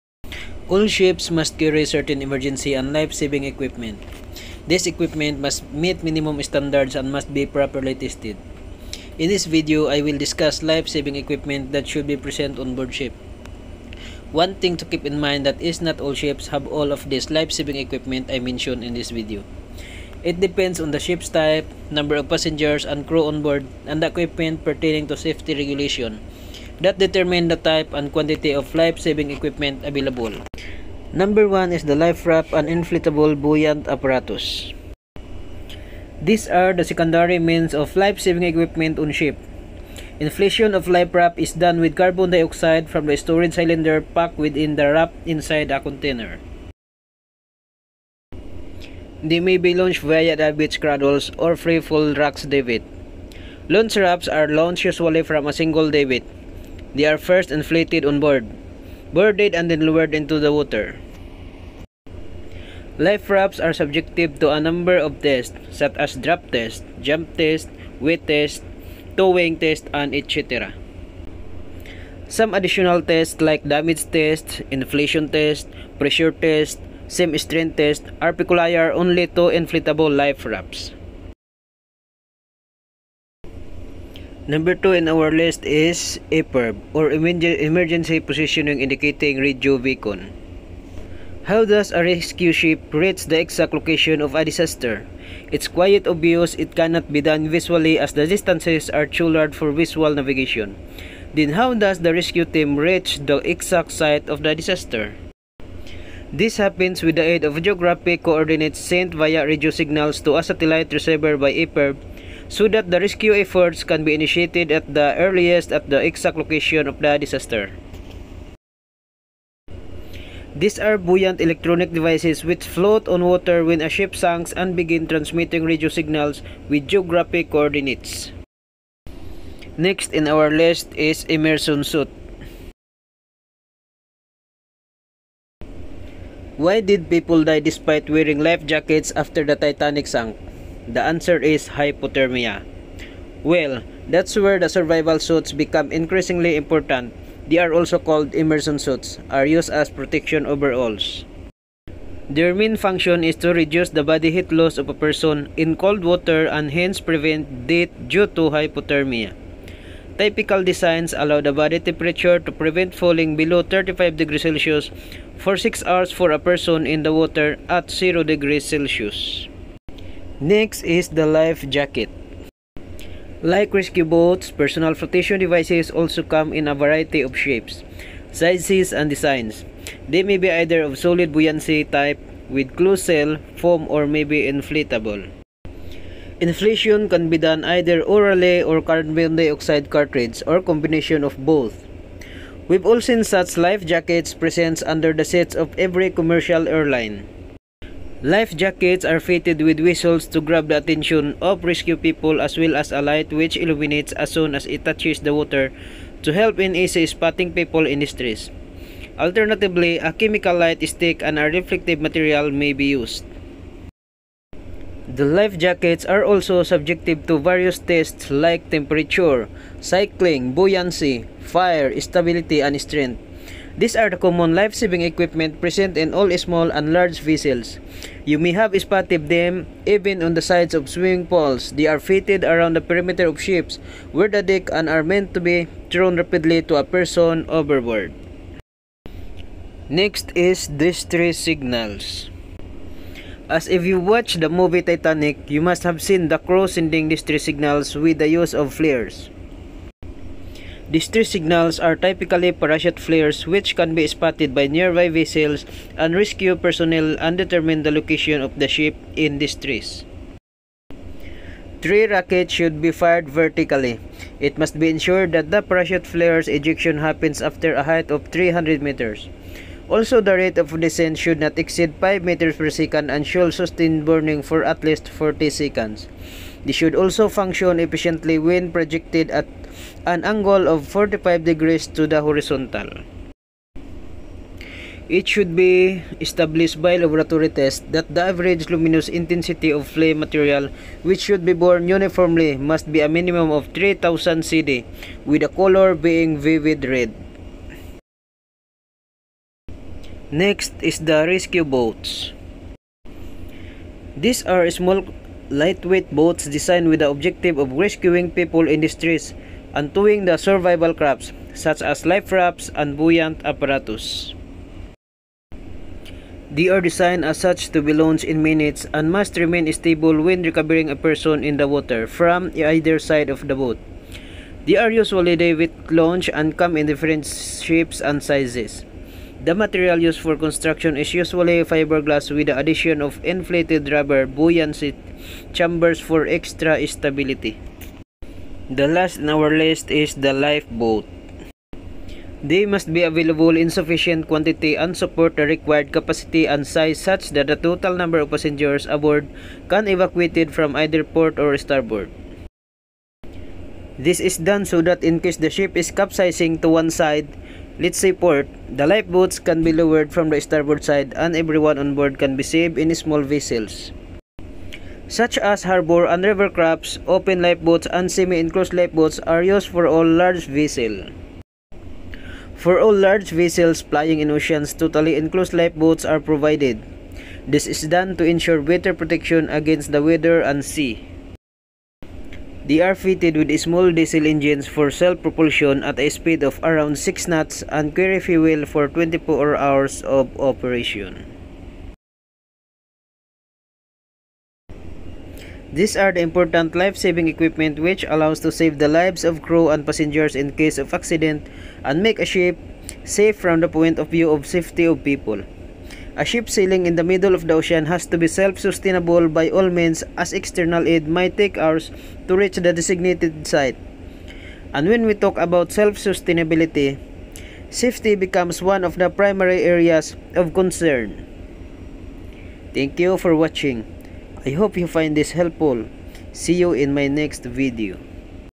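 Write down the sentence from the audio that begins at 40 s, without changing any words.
Inflation of life raft is done with carbon dioxide from the storage cylinder packed within the raft inside a container.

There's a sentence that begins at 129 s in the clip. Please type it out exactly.
Next in our list is immersion suit.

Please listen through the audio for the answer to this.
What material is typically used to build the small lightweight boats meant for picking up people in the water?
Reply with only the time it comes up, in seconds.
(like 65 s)
331 s.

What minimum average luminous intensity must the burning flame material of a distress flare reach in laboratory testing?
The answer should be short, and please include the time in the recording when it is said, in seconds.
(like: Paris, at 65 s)
3000 CD, at 293 s.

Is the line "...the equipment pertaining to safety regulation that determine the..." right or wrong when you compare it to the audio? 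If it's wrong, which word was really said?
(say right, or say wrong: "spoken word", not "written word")
right.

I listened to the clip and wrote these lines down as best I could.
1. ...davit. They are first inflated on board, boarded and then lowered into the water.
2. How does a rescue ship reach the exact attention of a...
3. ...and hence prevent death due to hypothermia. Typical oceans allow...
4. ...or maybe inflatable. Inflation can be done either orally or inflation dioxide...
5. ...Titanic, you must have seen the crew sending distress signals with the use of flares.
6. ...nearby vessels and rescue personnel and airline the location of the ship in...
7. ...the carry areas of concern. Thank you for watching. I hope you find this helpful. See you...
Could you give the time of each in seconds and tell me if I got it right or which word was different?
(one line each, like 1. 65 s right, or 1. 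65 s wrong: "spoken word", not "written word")
1. 55 s right
2. 91 s wrong: "location", not "attention"
3. 156 s wrong: "designs", not "oceans"
4. 183 s wrong: "carbon", not "inflation"
5. 244 s right
6. 254 s wrong: "determine", not "airline"
7. 418 s wrong: "primary", not "carry".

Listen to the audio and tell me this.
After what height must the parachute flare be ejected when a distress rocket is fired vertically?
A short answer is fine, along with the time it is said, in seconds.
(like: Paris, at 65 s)
300 meters, at 268 s.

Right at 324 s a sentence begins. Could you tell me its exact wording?
They are usually day with launch and come in different shapes and sizes.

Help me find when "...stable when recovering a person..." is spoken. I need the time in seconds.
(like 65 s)
319 s.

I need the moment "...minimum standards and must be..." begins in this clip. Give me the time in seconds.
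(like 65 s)
6 s.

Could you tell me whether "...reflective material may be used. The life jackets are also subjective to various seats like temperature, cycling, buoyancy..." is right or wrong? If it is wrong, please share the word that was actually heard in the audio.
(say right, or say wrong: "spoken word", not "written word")
wrong: "tests", not "seats".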